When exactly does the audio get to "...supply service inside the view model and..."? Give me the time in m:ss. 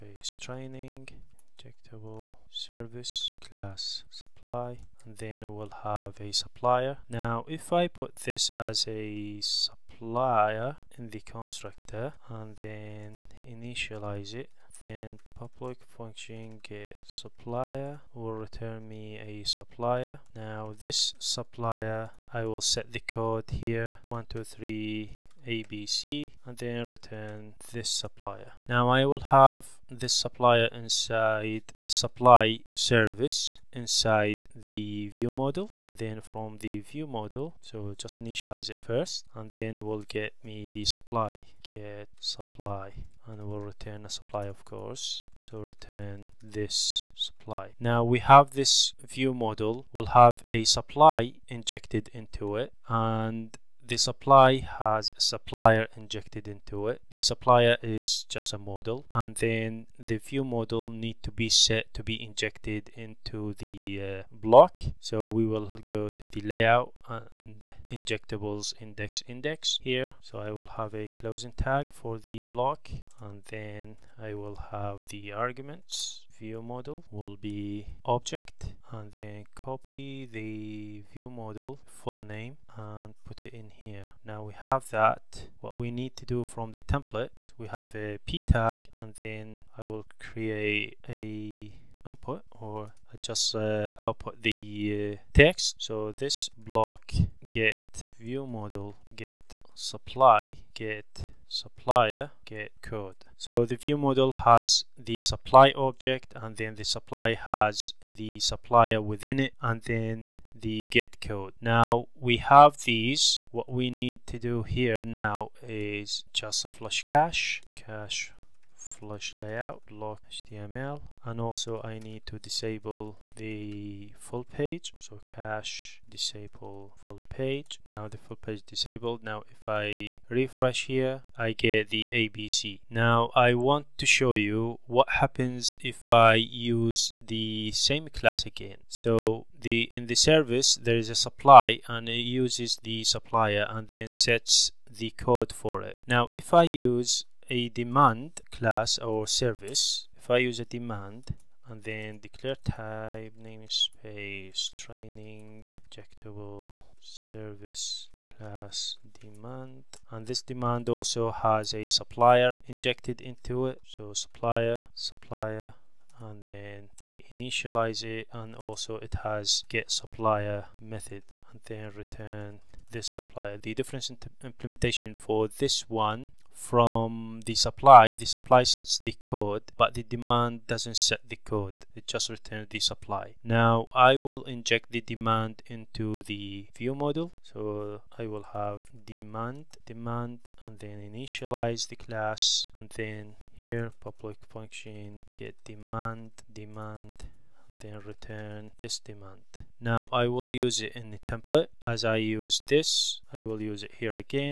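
0:31.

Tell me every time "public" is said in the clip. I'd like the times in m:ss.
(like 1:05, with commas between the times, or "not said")
0:15, 3:14.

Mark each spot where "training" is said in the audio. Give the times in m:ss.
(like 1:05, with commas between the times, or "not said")
0:00, 2:34.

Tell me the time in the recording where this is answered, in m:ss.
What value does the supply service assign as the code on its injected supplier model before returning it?
0:24.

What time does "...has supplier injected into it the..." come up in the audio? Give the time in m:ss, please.
0:54.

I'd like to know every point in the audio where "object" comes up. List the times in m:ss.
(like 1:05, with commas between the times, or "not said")
1:18, 1:45.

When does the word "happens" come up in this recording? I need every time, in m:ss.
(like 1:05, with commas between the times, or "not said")
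2:15.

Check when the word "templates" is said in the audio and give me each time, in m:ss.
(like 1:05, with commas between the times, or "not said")
1:26, 3:21.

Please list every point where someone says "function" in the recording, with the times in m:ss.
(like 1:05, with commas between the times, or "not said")
0:15, 3:14.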